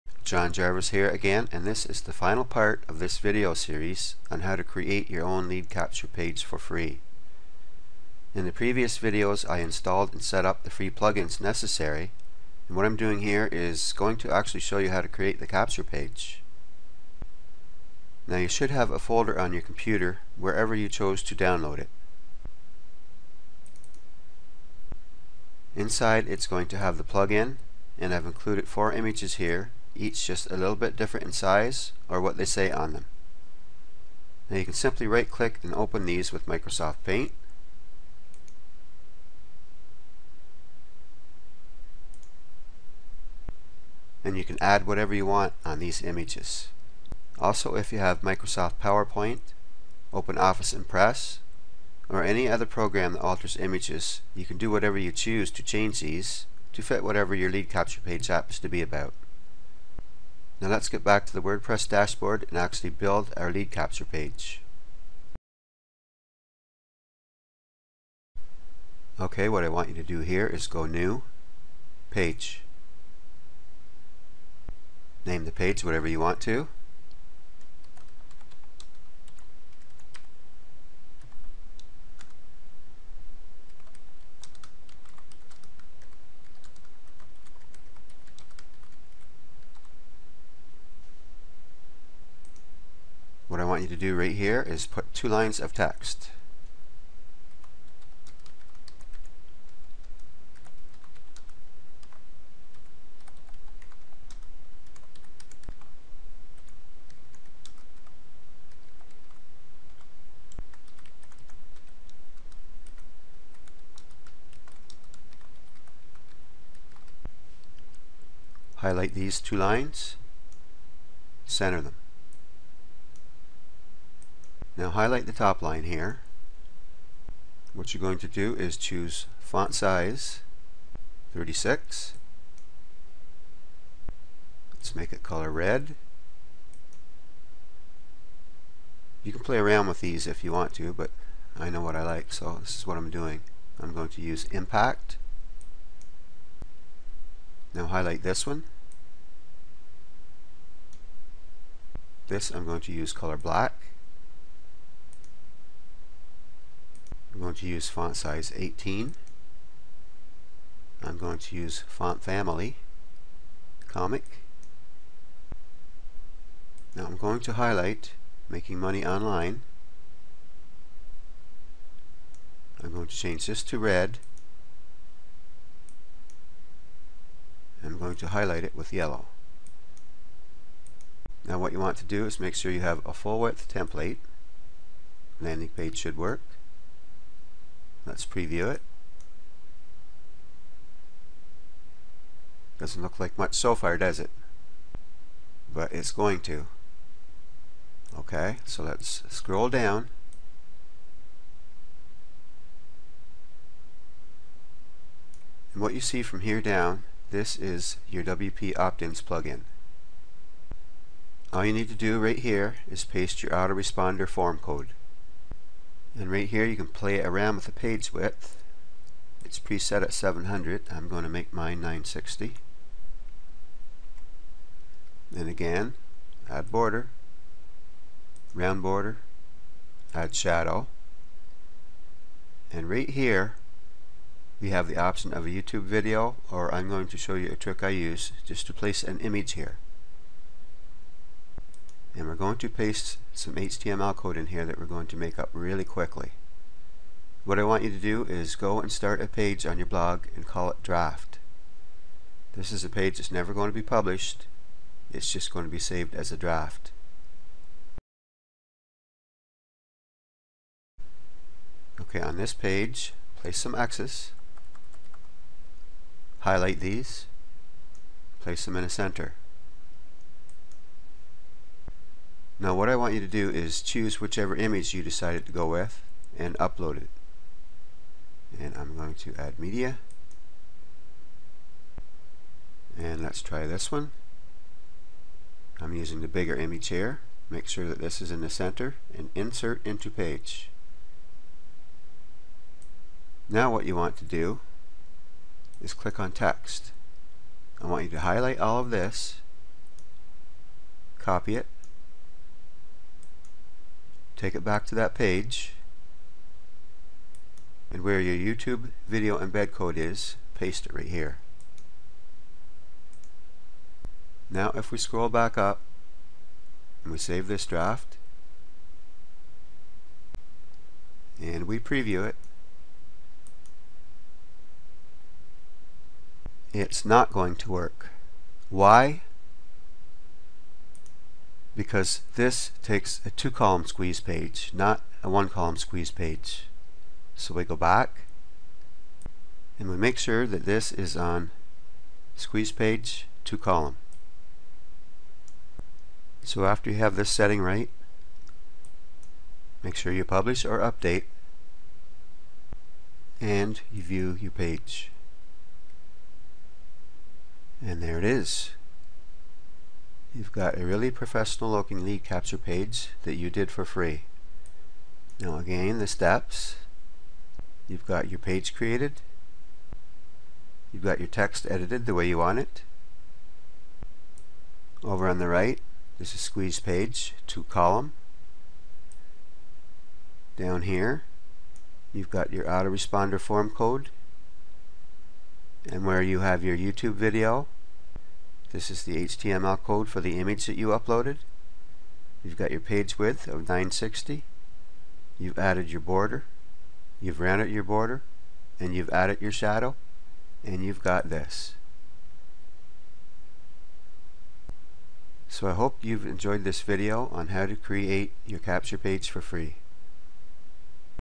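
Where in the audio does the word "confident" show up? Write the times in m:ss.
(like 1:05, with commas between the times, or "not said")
not said.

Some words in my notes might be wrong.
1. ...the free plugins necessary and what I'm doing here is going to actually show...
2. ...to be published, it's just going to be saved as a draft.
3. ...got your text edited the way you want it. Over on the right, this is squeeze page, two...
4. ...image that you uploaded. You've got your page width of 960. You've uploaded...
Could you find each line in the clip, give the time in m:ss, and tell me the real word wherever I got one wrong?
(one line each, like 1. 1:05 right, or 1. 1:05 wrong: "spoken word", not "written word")
1. 0:10 right
2. 4:13 right
3. 6:11 right
4. 6:30 wrong: "added", not "uploaded".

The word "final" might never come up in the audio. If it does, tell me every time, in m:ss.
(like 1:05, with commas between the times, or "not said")
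0:02.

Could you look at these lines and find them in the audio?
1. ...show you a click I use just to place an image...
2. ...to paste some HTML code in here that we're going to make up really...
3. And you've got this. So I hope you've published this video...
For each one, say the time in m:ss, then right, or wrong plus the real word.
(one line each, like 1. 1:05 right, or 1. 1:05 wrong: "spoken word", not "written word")
1. 3:57 wrong: "trick", not "click"
2. 4:02 right
3. 6:40 wrong: "enjoyed", not "published".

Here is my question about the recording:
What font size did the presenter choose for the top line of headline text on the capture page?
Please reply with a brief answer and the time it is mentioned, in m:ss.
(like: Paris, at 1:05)
36, at 2:09.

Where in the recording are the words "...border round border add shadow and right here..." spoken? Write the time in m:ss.
3:46.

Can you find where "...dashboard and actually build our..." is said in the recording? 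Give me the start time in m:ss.
1:01.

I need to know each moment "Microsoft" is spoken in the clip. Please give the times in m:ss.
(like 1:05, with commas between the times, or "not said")
0:36, 0:48.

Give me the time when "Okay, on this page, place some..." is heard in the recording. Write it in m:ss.
4:21.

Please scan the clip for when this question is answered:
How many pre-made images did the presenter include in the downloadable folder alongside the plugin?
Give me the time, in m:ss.
0:28.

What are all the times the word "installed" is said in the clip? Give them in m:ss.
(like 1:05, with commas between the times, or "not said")
0:09.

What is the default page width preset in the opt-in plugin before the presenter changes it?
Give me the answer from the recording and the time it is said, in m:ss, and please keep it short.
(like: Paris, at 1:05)
700, at 3:40.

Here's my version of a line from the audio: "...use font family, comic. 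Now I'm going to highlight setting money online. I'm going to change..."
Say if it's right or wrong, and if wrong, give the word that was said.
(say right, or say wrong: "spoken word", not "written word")
wrong: "making", not "setting".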